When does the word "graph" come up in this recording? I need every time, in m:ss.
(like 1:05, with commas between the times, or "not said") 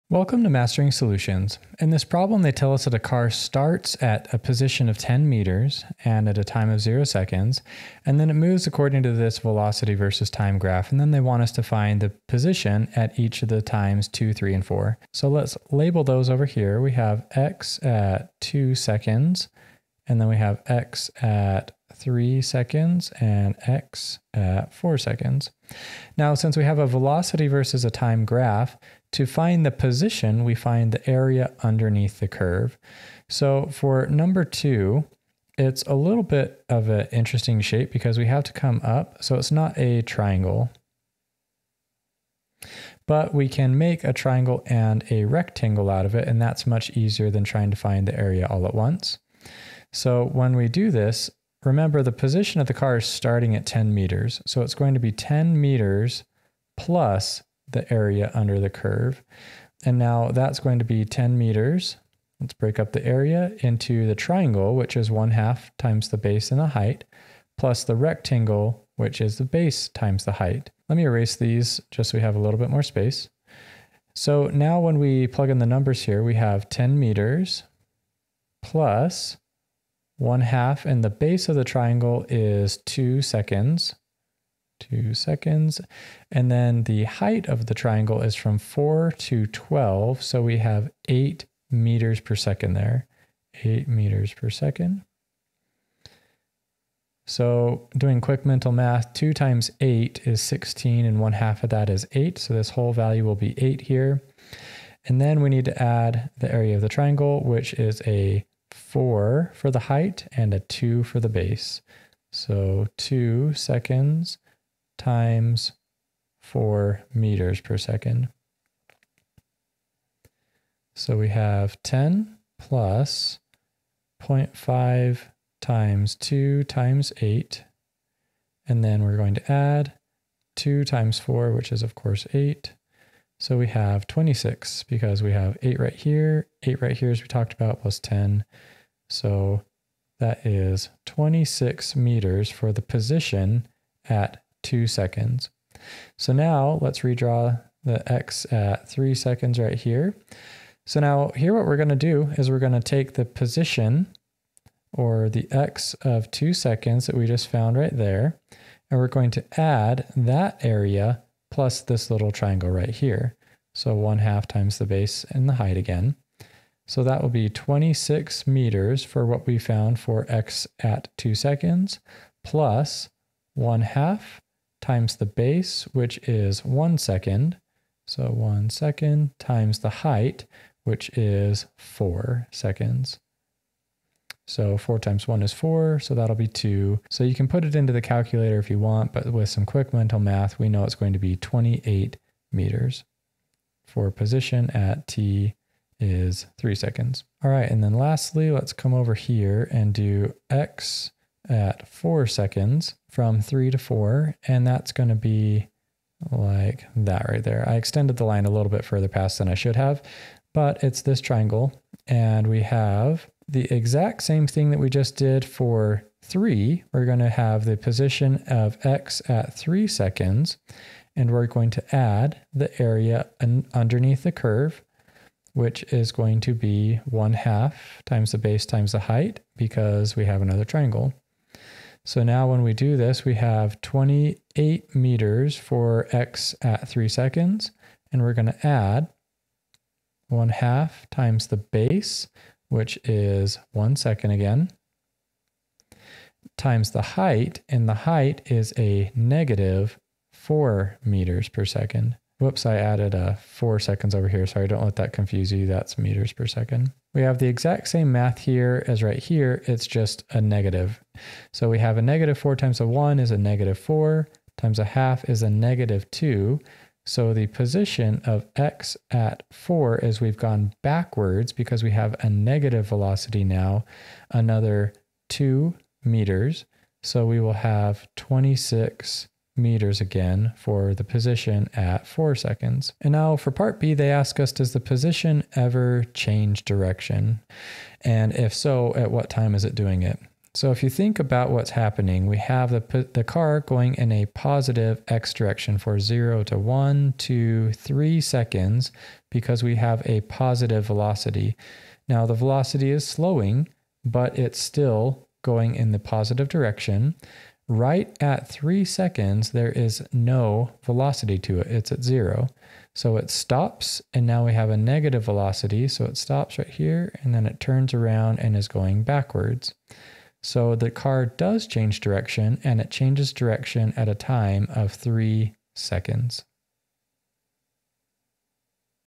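0:10, 0:28.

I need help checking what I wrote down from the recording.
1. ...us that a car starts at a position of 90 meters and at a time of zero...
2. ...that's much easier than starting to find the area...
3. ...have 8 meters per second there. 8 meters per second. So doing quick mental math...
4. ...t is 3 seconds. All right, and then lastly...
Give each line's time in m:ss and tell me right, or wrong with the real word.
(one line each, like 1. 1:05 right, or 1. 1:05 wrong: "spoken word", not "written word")
1. 0:02 wrong: "10", not "90"
2. 0:46 wrong: "trying", not "starting"
3. 1:30 right
4. 3:15 right.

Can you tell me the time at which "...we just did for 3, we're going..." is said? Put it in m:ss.
3:34.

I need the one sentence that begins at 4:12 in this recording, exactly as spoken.
Whoops, I added a uh, four seconds over here.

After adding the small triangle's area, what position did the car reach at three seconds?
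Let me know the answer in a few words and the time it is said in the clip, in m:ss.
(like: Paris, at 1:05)
28 meters, at 3:11.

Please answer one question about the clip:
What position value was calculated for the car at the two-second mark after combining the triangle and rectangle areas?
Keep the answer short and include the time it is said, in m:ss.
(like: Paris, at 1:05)
26 meters, at 2:21.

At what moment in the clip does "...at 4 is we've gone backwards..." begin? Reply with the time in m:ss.
4:29.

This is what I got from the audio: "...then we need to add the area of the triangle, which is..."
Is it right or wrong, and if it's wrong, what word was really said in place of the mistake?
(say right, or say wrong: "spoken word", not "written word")
right.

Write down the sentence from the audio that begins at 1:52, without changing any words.
So two seconds times four meters per second.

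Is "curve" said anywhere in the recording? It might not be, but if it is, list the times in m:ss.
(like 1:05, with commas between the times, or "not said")
0:32, 0:58, 3:44.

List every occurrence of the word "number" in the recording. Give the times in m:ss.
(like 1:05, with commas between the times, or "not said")
0:34, 1:15.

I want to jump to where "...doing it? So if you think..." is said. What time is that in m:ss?
4:49.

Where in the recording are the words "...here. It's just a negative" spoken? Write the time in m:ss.
4:19.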